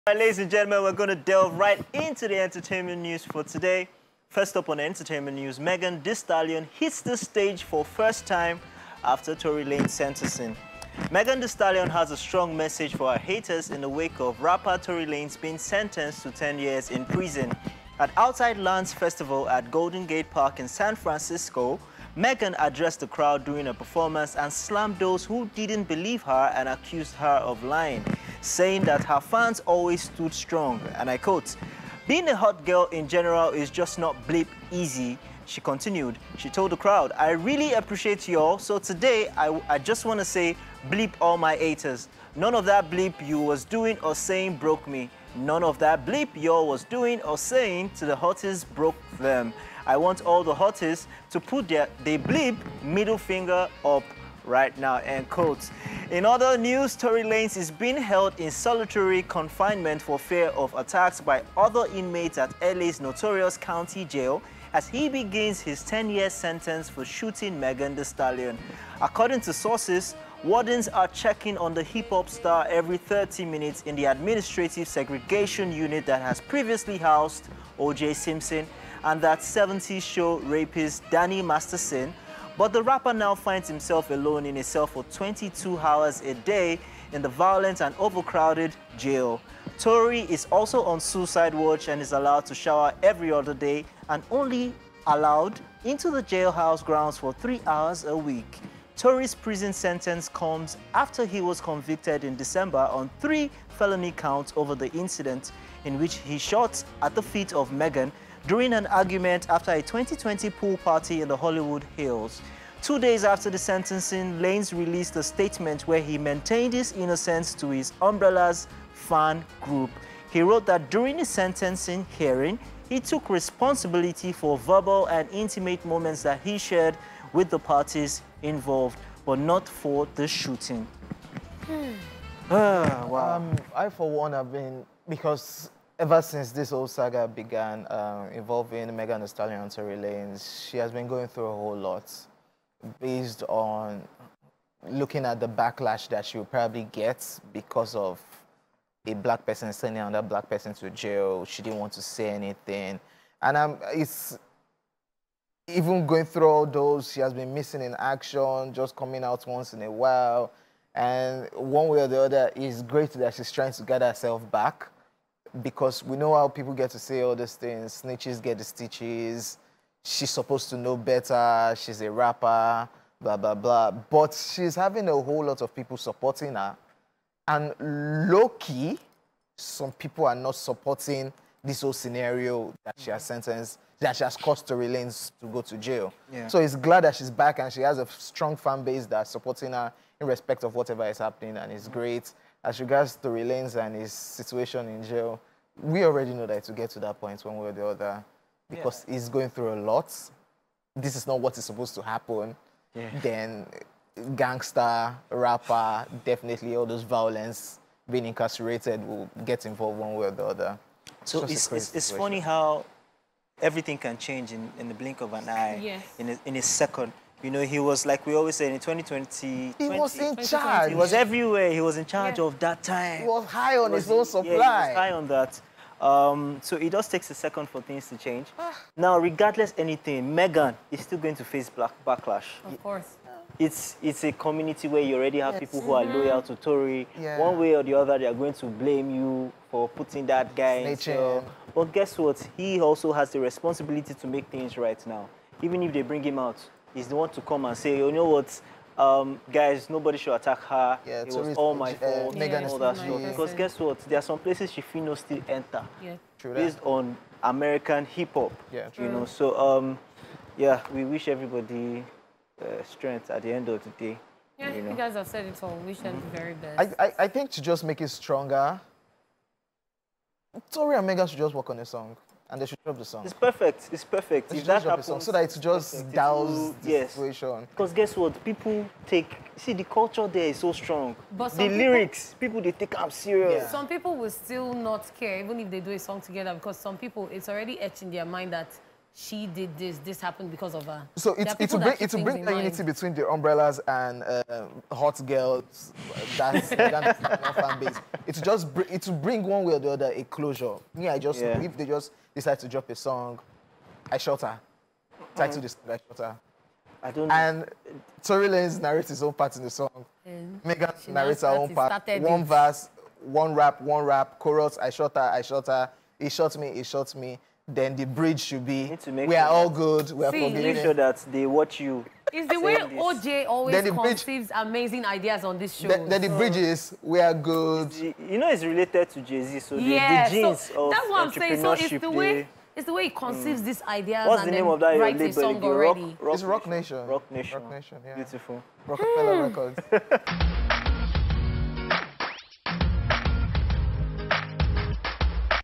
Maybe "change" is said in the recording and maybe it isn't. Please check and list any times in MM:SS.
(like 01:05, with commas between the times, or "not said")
03:34, 03:48.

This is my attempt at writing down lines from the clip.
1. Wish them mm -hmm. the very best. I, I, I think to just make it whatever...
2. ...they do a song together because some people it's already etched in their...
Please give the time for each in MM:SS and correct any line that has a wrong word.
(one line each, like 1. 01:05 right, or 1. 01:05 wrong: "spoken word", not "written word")
1. 04:25 wrong: "stronger", not "whatever"
2. 04:45 right.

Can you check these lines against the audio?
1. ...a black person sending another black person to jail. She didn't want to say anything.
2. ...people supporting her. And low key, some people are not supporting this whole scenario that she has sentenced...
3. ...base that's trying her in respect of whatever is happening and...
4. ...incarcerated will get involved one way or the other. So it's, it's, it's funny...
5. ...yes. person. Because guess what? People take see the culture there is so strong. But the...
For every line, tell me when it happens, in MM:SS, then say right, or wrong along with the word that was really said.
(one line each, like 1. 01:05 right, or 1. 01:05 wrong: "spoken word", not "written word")
1. 02:29 right
2. 02:55 right
3. 03:08 wrong: "supporting", not "trying"
4. 03:28 right
5. 04:36 wrong: "situation", not "person".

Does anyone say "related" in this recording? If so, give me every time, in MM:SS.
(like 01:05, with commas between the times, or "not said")
05:28.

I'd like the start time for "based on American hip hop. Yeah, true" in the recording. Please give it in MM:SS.
04:16.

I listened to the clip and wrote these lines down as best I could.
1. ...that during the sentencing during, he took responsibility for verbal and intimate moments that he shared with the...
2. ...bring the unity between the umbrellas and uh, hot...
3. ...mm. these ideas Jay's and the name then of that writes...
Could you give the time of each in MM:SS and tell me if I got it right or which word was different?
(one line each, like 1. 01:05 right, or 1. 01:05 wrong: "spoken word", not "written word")
1. 02:00 wrong: "hearing", not "during"
2. 04:52 right
3. 05:33 wrong: "What", not "Jay".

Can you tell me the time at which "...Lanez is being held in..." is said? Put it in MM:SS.
00:57.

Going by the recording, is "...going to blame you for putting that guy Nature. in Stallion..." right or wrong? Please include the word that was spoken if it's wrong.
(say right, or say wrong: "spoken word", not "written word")
wrong: "But", not "Stallion".